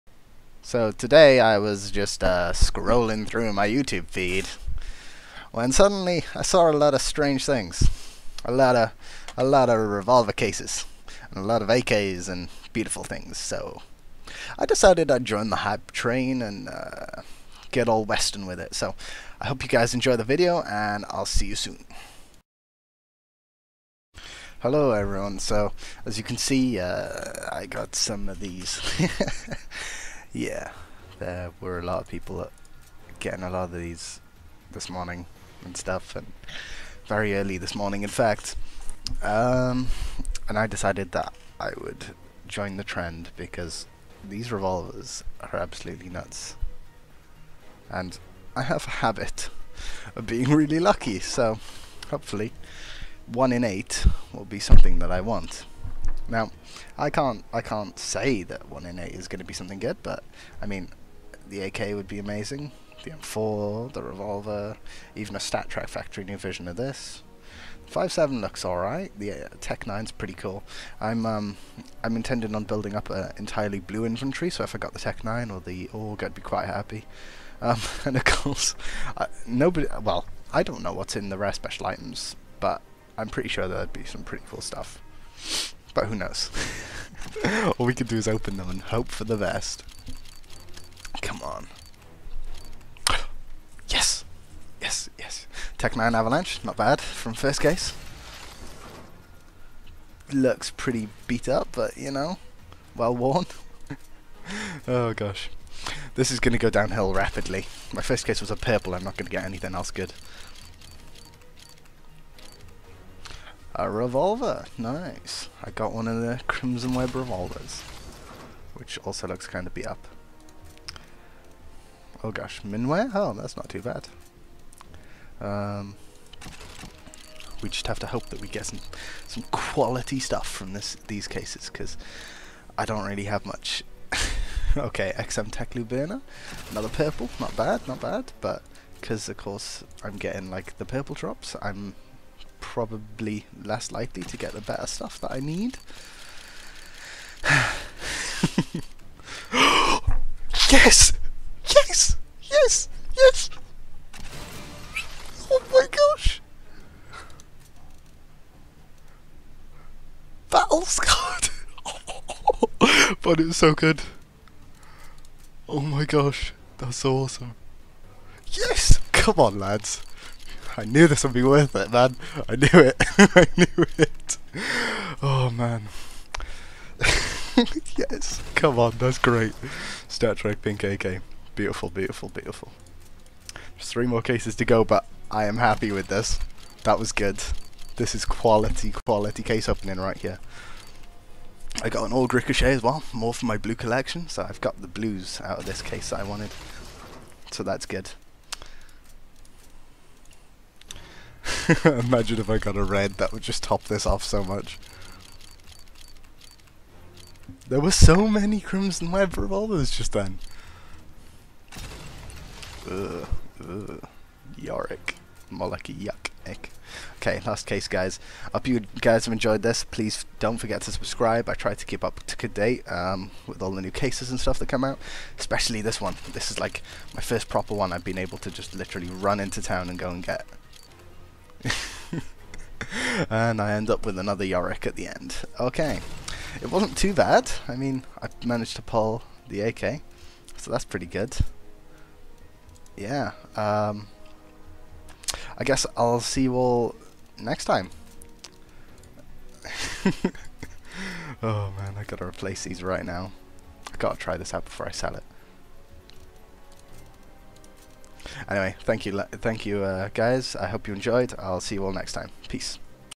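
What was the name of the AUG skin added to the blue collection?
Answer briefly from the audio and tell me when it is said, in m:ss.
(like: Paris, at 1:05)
Ricochet, at 3:12.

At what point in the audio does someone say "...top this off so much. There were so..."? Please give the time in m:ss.
3:23.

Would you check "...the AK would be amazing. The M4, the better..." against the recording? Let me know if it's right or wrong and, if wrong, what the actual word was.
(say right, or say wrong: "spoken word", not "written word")
wrong: "revolver", not "better".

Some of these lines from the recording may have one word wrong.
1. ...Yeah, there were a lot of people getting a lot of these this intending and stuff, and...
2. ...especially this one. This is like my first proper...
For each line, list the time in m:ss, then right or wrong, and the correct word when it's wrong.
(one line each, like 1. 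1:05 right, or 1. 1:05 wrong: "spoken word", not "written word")
1. 0:30 wrong: "morning", not "intending"
2. 3:45 right.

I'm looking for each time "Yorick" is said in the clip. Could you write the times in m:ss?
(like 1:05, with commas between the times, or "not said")
3:34, 3:54.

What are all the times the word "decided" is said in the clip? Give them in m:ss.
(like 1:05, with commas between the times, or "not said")
0:14, 0:40.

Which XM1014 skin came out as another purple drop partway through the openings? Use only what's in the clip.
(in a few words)
Teclu Burner.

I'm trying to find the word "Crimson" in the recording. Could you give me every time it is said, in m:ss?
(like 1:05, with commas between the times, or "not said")
1:56, 3:28.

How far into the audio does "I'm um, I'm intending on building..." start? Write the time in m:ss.
1:11.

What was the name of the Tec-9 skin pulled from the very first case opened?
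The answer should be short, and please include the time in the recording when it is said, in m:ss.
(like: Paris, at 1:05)
Avalanche, at 1:35.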